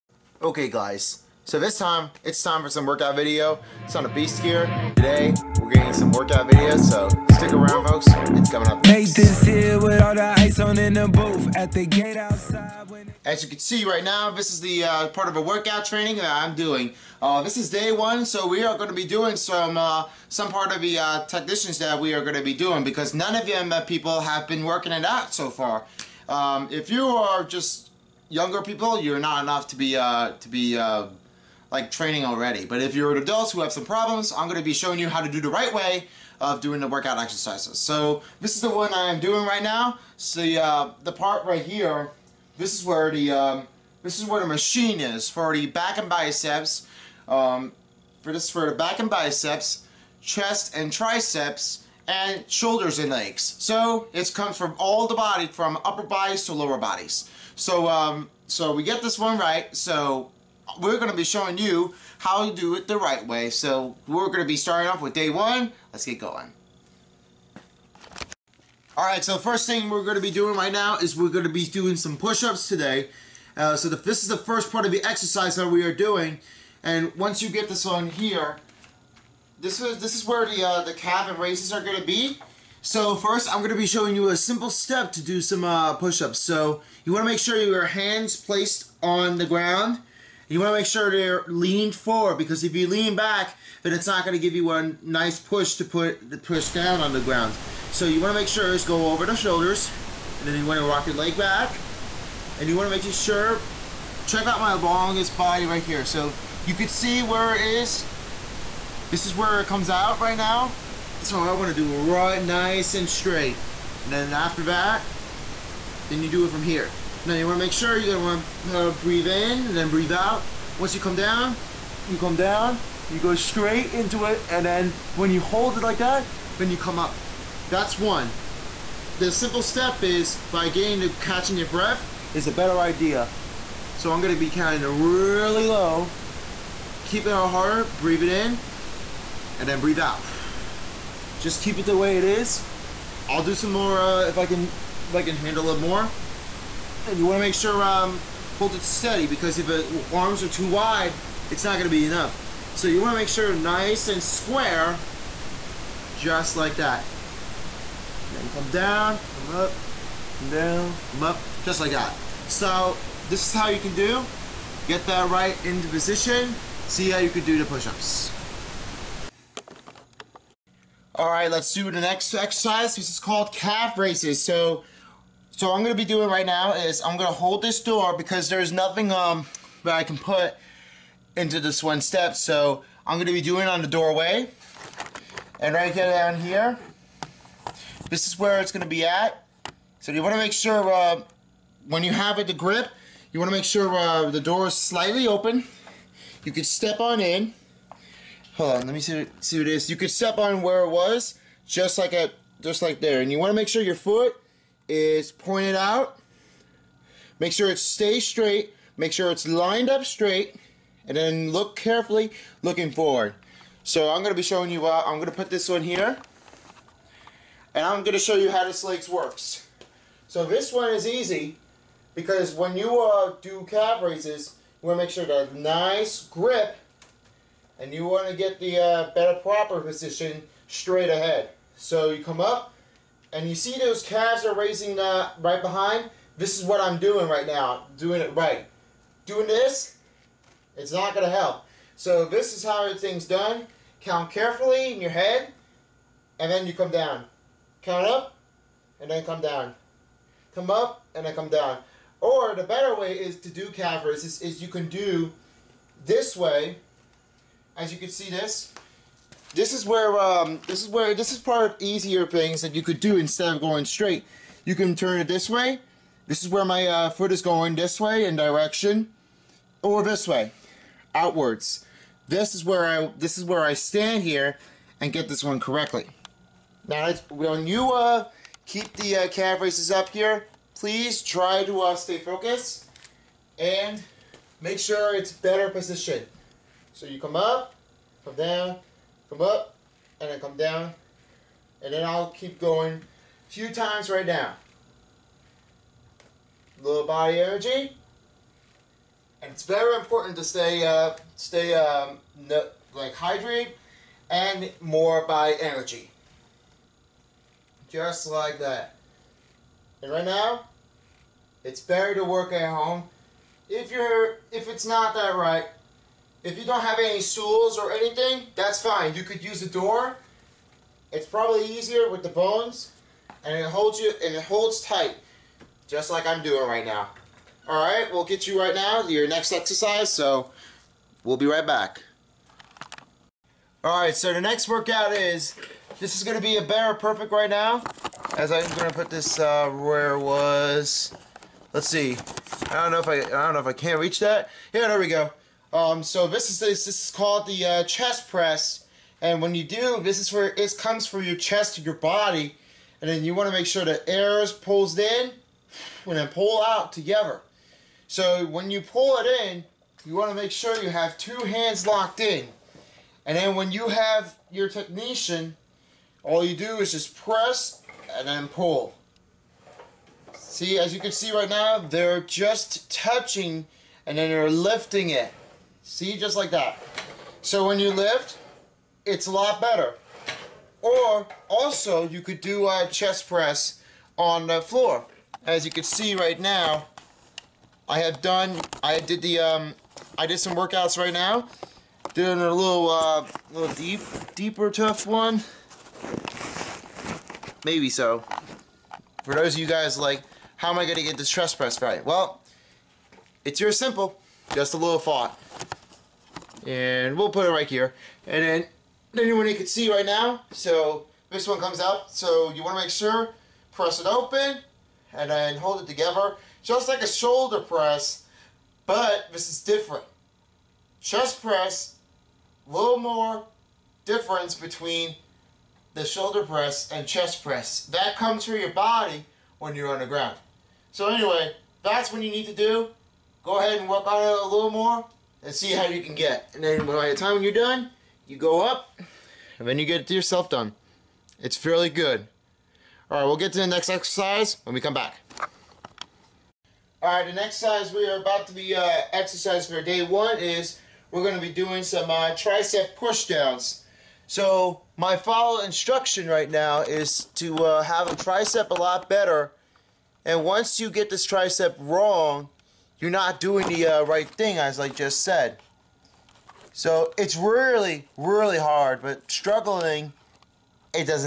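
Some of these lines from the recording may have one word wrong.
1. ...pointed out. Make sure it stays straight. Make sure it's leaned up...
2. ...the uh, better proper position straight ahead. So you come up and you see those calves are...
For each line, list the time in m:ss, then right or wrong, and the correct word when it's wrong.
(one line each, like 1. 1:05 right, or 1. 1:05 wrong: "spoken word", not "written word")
1. 3:25 wrong: "lined", not "leaned"
2. 3:48 right.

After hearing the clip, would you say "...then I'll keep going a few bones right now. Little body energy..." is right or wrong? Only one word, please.
wrong.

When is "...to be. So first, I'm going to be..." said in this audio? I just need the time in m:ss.
1:21.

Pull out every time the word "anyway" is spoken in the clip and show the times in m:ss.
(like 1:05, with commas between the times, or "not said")
7:11.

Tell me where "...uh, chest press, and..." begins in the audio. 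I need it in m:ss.
5:47.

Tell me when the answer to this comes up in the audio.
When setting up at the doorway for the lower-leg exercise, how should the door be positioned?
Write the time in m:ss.
3:14.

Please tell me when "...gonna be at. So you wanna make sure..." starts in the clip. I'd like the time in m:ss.
3:08.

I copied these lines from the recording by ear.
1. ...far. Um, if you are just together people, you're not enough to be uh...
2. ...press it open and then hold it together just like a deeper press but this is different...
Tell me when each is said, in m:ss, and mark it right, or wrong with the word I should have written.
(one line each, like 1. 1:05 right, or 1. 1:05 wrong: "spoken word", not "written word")
1. 0:25 wrong: "younger", not "together"
2. 6:53 wrong: "shoulder", not "deeper".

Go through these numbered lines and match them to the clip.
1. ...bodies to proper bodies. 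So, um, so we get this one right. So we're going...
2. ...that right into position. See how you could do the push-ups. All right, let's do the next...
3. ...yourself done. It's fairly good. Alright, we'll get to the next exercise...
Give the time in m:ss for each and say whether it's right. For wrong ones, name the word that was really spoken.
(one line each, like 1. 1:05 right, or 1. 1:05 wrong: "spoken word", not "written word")
1. 0:56 wrong: "lower", not "proper"
2. 2:45 right
3. 7:20 right.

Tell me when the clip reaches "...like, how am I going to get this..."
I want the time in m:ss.
6:39.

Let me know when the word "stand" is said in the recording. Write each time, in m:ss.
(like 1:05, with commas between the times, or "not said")
4:33.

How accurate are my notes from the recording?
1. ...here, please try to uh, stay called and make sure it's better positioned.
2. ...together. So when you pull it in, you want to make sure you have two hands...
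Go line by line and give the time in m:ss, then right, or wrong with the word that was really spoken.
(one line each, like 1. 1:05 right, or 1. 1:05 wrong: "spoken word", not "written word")
1. 4:40 wrong: "focused", not "called"
2. 5:56 right.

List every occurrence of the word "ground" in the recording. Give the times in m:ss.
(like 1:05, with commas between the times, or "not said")
1:29, 1:37, 7:10.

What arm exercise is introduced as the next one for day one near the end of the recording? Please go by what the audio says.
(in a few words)
Tricep pushdowns.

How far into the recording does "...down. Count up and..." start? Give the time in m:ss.
4:06.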